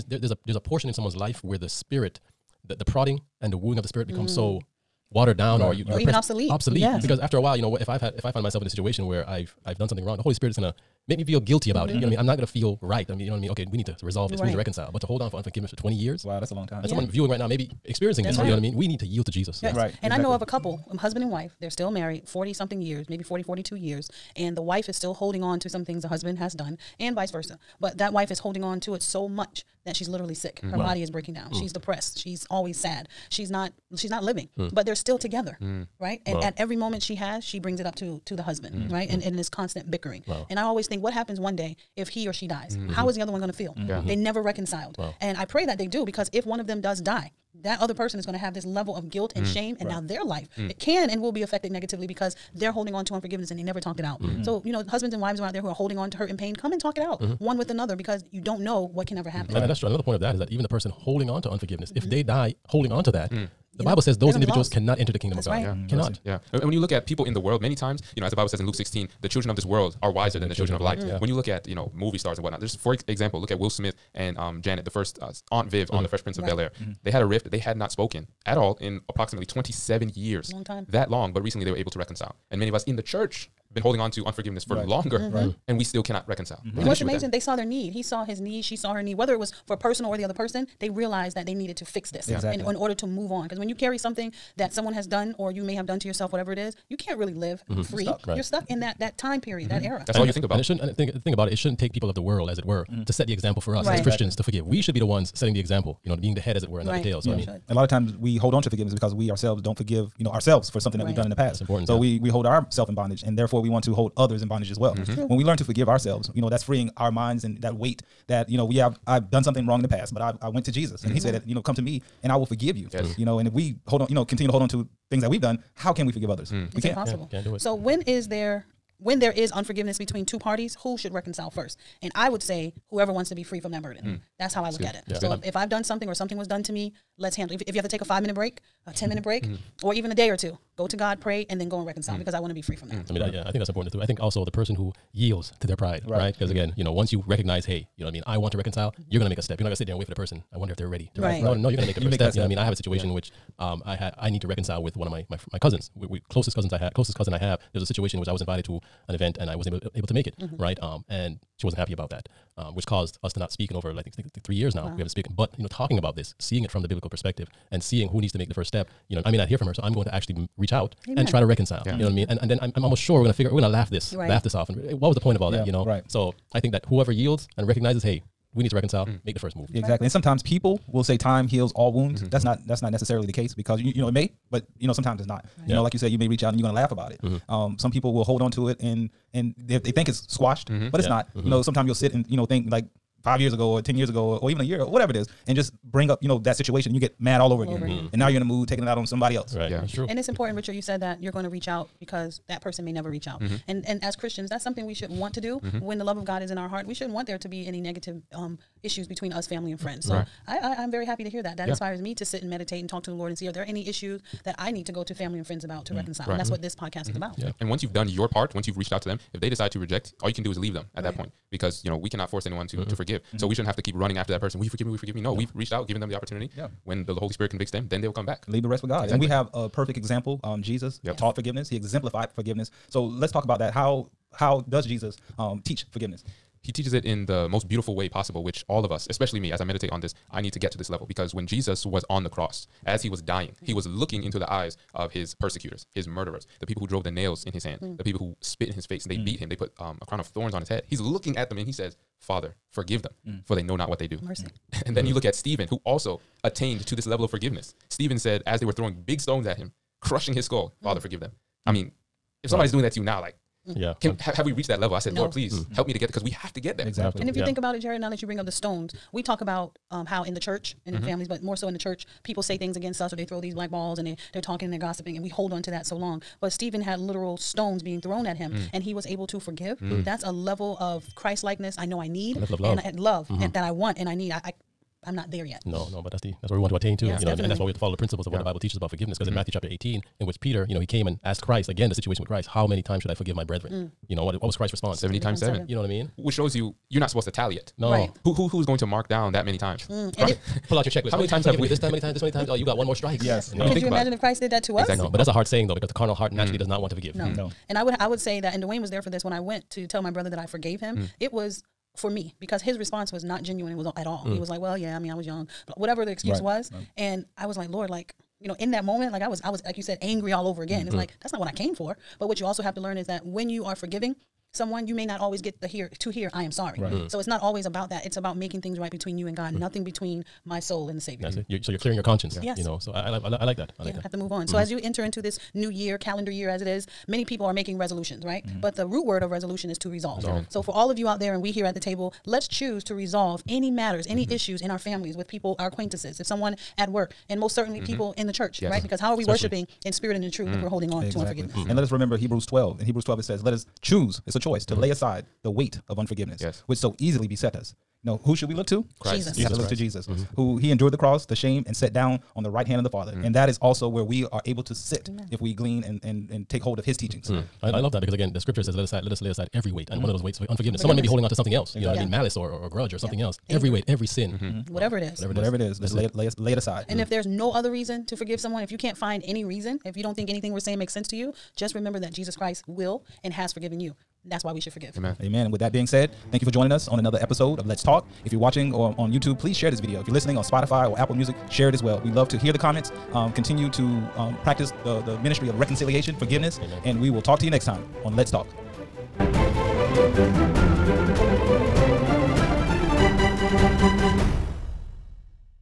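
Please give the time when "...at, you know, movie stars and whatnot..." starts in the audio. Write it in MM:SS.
01:11.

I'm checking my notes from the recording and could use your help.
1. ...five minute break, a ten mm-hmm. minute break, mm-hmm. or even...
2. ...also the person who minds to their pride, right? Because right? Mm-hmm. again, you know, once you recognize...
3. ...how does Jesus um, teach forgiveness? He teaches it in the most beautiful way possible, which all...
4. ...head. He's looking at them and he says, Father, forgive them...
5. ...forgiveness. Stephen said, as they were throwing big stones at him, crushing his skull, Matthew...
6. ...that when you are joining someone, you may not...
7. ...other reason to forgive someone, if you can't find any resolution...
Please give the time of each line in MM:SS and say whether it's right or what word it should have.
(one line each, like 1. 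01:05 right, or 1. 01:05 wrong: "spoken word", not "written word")
1. 02:18 right
2. 02:24 wrong: "yields", not "minds"
3. 03:54 right
4. 04:10 right
5. 04:17 wrong: "Father", not "Matthew"
6. 05:23 wrong: "forgiving", not "joining"
7. 06:17 wrong: "reason", not "resolution".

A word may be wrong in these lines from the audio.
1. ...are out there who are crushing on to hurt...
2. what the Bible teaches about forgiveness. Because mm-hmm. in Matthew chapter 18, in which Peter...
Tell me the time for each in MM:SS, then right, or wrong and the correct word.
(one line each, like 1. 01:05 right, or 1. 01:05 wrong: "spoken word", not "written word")
1. 00:55 wrong: "holding", not "crushing"
2. 04:48 right.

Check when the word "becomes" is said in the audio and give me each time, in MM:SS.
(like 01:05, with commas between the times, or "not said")
00:04.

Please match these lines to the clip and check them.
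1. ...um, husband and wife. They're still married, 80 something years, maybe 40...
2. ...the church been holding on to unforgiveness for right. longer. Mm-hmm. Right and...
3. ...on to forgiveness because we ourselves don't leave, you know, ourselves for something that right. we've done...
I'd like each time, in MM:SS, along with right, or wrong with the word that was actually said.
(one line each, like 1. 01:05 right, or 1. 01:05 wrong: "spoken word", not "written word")
1. 00:20 wrong: "40", not "80"
2. 01:22 right
3. 01:48 wrong: "forgive", not "leave".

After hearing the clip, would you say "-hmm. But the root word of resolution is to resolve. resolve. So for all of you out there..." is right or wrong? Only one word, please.
right.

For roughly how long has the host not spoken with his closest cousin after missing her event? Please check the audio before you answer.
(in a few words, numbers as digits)
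3 years.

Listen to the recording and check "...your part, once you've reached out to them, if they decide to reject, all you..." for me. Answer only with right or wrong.
right.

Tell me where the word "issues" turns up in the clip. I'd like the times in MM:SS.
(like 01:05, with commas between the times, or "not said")
03:28, 03:33, 05:44.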